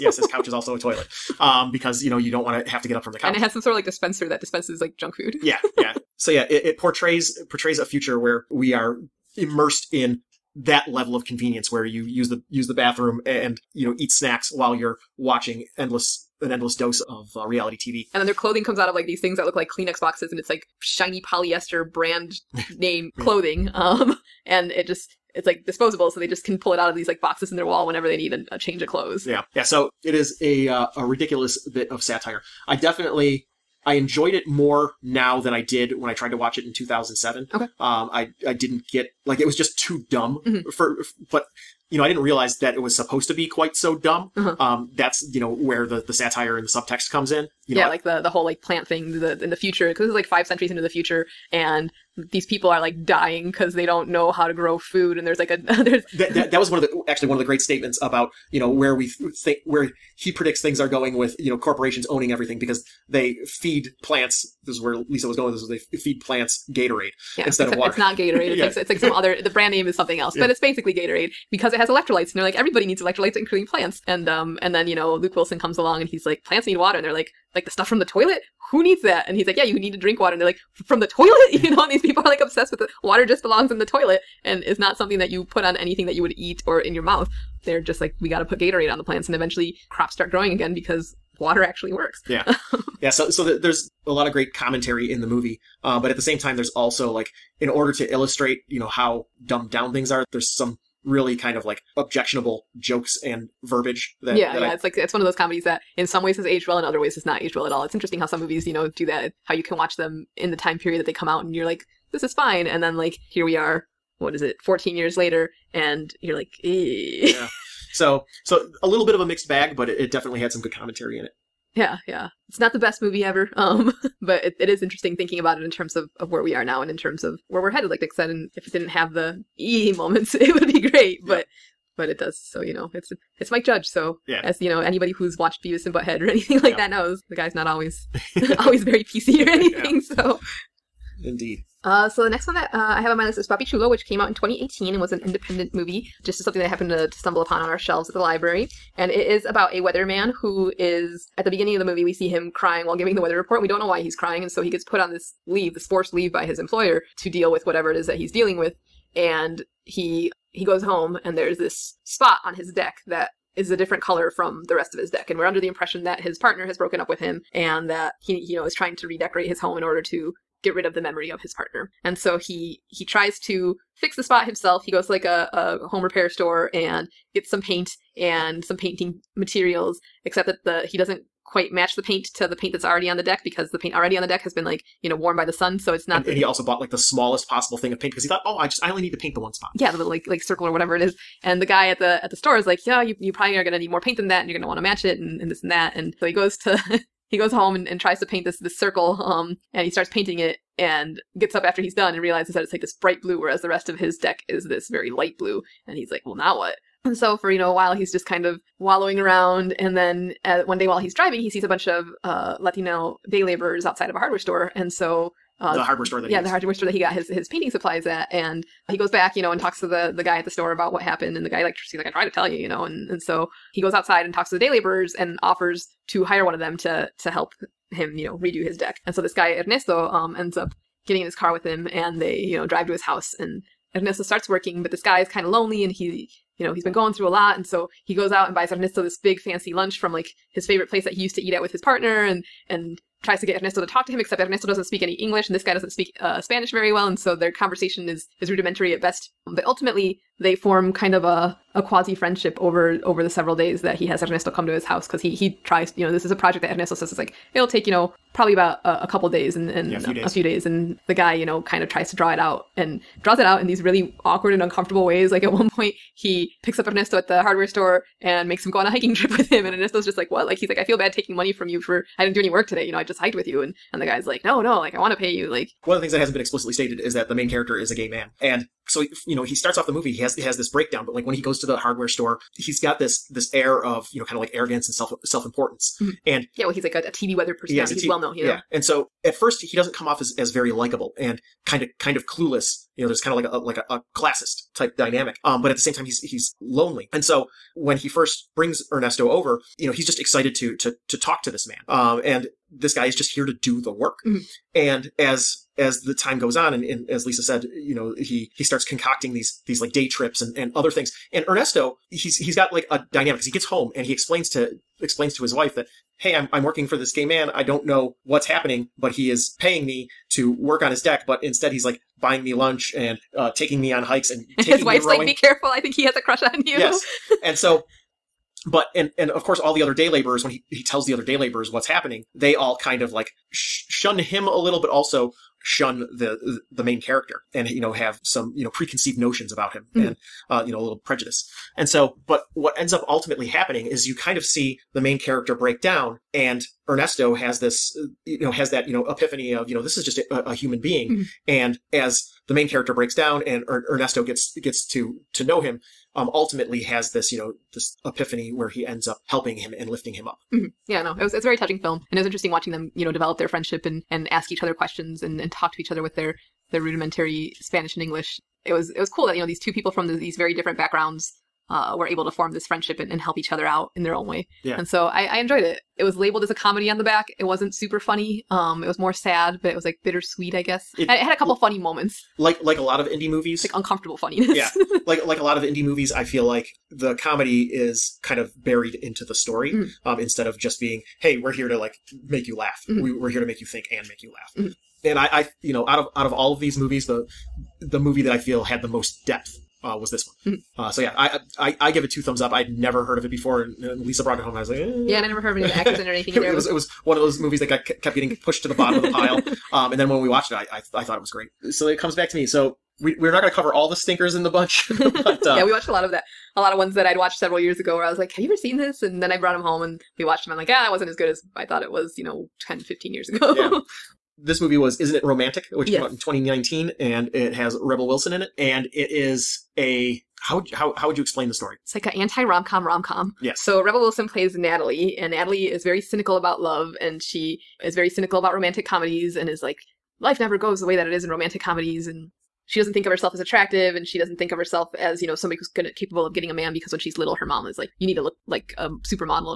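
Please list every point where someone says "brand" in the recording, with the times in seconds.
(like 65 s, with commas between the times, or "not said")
21 s, 69 s.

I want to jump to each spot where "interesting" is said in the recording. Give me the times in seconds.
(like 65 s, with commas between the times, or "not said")
107 s, 124 s, 362 s.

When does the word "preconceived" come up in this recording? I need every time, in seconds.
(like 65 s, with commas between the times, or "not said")
338 s.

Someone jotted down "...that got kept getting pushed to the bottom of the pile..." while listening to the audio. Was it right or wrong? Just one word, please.
right.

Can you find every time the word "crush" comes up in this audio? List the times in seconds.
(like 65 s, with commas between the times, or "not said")
326 s.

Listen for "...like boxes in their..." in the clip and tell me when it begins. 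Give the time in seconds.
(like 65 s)
27 s.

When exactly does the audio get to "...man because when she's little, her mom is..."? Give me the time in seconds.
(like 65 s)
446 s.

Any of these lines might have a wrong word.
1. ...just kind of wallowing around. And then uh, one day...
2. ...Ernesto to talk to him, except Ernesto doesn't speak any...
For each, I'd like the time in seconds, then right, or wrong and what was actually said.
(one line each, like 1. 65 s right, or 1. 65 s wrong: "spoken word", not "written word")
1. 208 s right
2. 243 s right.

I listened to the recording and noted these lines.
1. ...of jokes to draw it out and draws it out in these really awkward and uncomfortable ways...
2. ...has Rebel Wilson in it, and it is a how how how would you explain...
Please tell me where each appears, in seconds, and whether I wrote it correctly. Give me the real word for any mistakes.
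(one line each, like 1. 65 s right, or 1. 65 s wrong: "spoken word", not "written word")
1. 261 s wrong: "tries", not "jokes"
2. 427 s right.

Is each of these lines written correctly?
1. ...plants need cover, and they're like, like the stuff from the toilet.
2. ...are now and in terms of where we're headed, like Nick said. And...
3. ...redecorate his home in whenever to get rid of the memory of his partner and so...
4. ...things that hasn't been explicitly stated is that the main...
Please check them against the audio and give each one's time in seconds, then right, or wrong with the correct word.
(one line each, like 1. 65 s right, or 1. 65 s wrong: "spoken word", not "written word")
1. 76 s wrong: "water", not "cover"
2. 126 s right
3. 169 s wrong: "order", not "whenever"
4. 276 s right.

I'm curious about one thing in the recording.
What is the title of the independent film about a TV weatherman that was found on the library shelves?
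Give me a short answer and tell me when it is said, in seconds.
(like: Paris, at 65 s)
Papi Chulo, at 143 s.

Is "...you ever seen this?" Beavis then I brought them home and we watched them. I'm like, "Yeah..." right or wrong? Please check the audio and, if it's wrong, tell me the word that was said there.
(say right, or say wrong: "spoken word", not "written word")
wrong: "And", not "Beavis".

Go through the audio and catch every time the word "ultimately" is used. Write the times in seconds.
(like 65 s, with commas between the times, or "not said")
249 s, 343 s, 356 s.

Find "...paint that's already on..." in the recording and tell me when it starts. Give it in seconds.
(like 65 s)
182 s.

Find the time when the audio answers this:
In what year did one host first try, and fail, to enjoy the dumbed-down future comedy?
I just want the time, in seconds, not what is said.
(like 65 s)
36 s.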